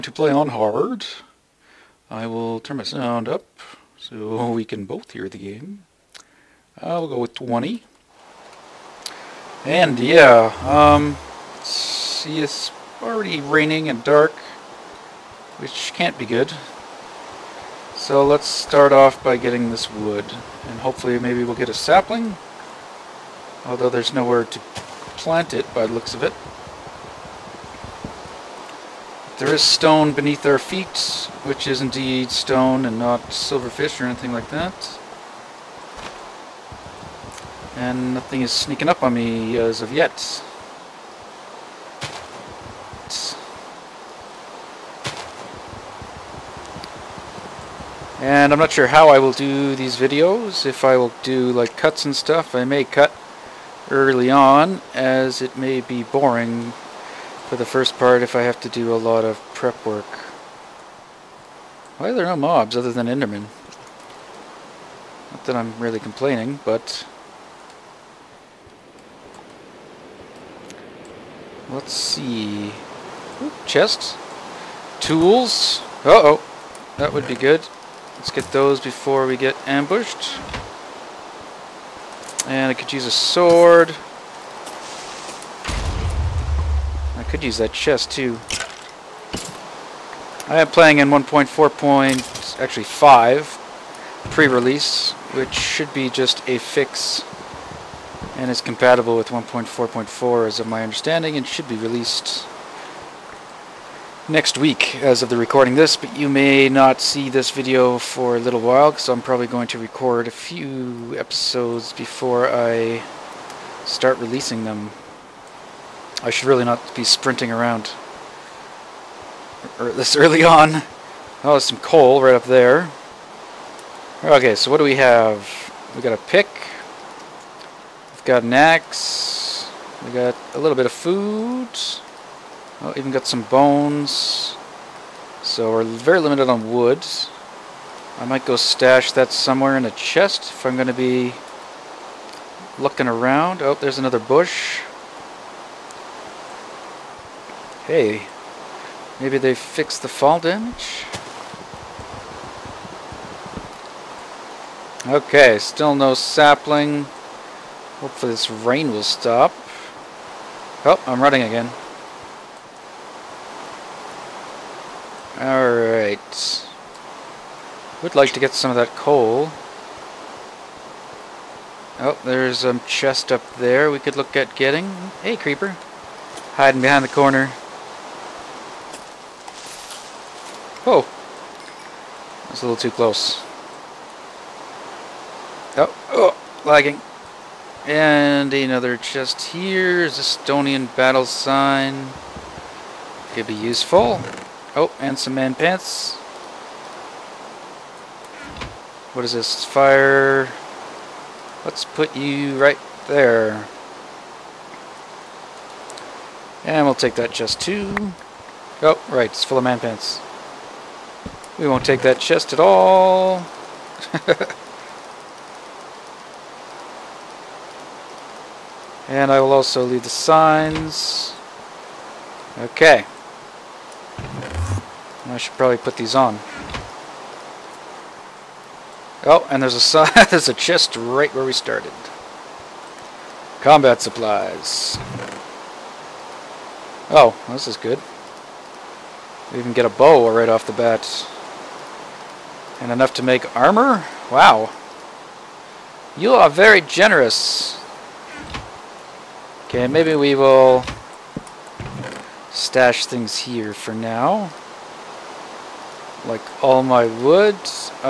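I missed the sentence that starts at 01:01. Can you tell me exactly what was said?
Why are there no mobs other than Endermen?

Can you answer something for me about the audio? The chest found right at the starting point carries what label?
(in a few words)
Combat supplies.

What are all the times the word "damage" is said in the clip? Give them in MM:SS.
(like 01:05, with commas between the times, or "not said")
02:30.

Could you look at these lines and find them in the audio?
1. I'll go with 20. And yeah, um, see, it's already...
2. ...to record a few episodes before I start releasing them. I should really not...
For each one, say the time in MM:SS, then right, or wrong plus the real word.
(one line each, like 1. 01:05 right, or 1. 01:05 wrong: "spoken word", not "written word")
1. 00:06 right
2. 01:49 right.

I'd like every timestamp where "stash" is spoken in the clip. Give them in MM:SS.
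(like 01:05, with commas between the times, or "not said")
02:18, 04:12.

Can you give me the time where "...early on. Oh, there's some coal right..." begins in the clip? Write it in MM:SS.
02:00.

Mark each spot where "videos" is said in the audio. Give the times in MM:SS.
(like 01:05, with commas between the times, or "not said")
00:49, 01:47.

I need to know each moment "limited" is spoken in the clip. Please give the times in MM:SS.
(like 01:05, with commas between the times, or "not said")
02:16.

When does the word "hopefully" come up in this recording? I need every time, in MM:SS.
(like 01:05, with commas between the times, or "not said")
00:20, 02:37.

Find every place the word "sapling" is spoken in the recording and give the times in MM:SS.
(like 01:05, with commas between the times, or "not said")
00:21, 02:36.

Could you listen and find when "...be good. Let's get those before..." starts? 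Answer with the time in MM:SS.
01:17.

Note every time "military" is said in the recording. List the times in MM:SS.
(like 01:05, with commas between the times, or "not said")
not said.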